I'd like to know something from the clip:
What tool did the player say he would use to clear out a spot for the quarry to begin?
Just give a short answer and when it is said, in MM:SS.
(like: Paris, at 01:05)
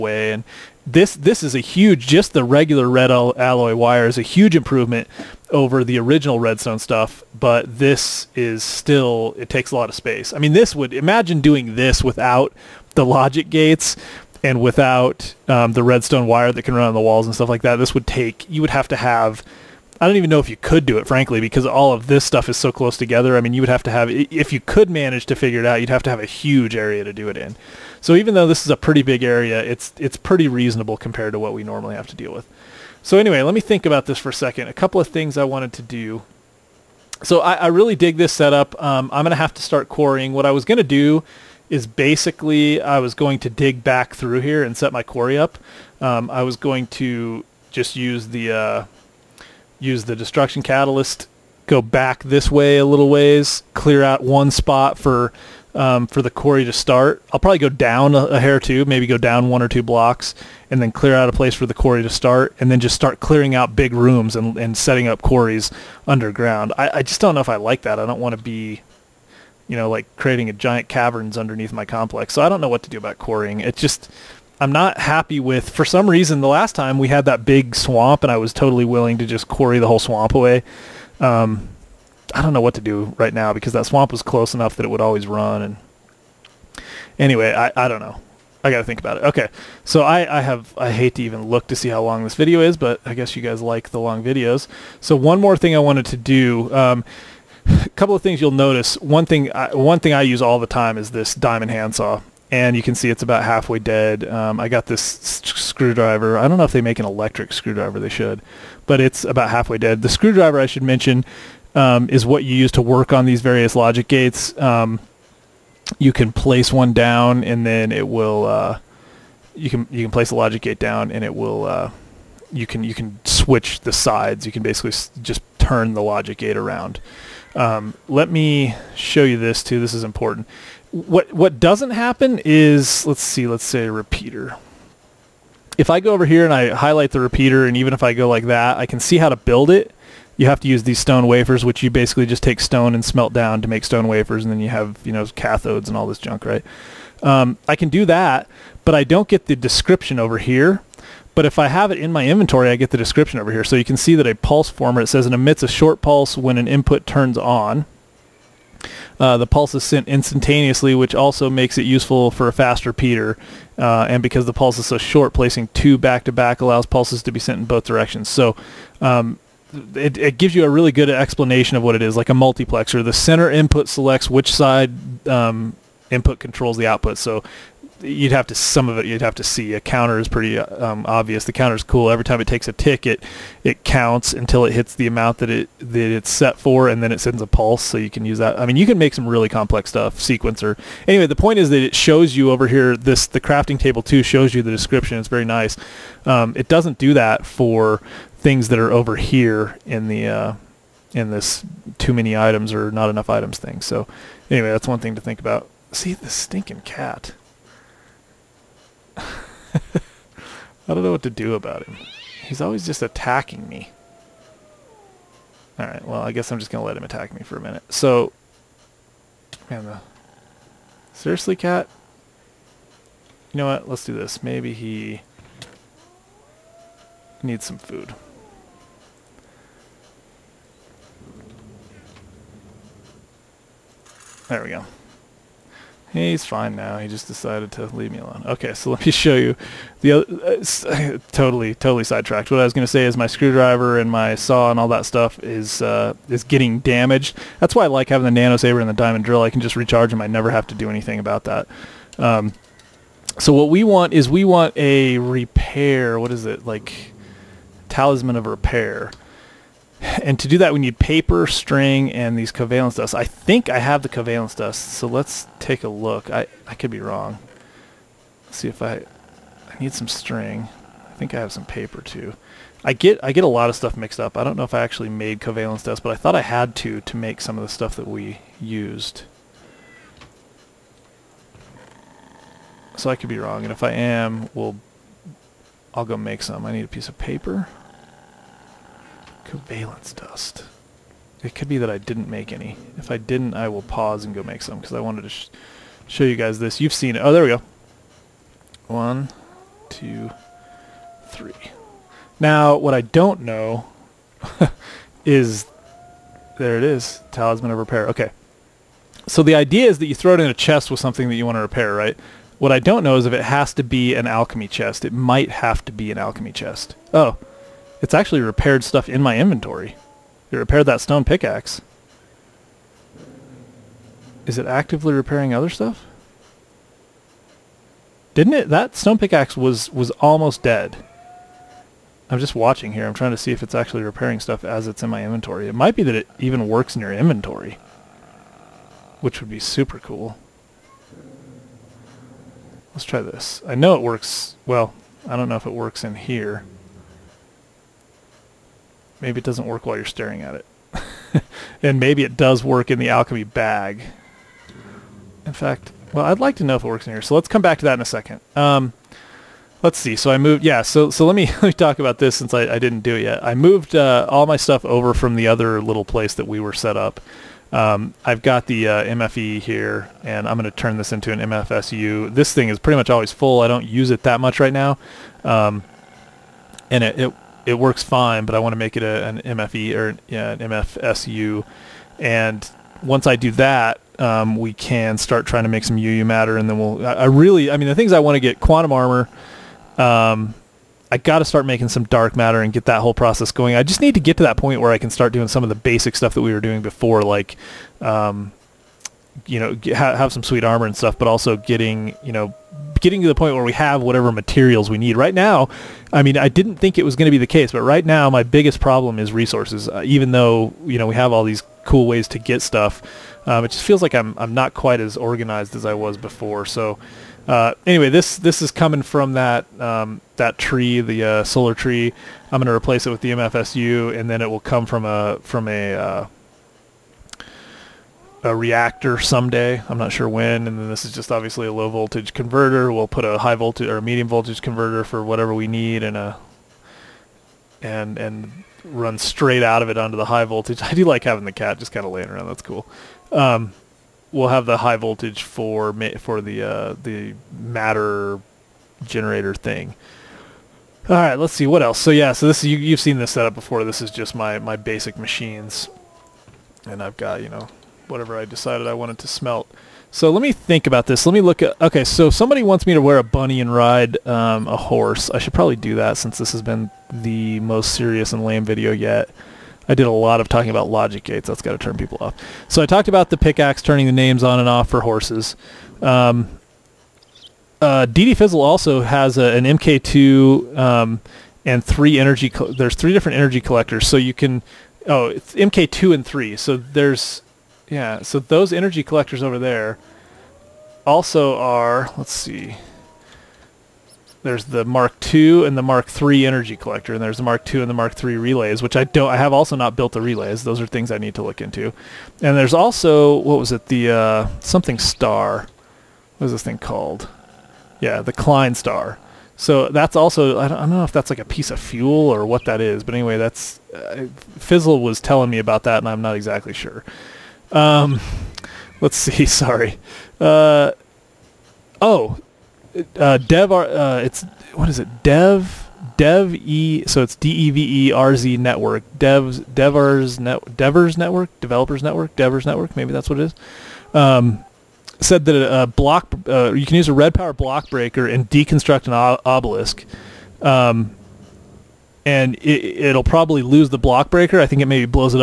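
destruction catalyst, at 00:50.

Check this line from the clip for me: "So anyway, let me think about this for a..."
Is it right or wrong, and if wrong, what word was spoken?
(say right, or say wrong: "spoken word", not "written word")
right.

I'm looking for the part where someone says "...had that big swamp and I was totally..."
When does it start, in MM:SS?
01:17.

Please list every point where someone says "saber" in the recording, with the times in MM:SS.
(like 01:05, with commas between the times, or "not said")
04:08.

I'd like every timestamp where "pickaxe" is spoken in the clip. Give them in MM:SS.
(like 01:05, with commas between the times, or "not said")
05:21, 05:29, 07:53.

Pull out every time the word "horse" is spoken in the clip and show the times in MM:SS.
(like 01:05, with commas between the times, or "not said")
07:44, 07:55.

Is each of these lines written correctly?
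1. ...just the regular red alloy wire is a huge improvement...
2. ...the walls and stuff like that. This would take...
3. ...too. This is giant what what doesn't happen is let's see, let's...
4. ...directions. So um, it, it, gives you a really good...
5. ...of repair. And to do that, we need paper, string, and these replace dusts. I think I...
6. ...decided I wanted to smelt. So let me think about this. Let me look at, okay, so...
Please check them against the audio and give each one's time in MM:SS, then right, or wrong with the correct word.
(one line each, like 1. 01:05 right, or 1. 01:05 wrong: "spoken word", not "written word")
1. 00:02 right
2. 00:16 right
3. 02:09 wrong: "important", not "giant"
4. 02:47 right
5. 04:18 wrong: "covalence", not "replace"
6. 07:38 right.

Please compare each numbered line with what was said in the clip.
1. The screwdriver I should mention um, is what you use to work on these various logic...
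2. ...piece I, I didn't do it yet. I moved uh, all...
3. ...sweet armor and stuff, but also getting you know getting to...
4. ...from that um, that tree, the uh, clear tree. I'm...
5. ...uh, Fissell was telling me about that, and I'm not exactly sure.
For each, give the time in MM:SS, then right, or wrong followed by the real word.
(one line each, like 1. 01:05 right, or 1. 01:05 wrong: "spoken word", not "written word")
1. 01:50 right
2. 06:02 wrong: "since", not "piece"
3. 06:40 right
4. 06:59 wrong: "solar", not "clear"
5. 08:33 right.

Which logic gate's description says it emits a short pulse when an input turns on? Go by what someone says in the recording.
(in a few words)
pulse former.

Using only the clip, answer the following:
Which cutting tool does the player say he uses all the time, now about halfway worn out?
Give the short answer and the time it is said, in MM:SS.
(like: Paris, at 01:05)
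diamond handsaw, at 01:41.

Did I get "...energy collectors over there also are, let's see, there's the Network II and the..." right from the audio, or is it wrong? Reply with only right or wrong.
wrong.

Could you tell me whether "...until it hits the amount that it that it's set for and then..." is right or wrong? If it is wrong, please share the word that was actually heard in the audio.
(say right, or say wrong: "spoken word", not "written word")
right.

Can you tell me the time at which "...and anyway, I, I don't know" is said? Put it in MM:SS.
01:25.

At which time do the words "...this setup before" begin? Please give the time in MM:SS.
07:33.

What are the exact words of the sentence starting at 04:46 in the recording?
I need a piece of paper valence dust.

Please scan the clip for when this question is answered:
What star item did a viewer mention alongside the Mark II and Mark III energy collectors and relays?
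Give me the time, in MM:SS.
08:28.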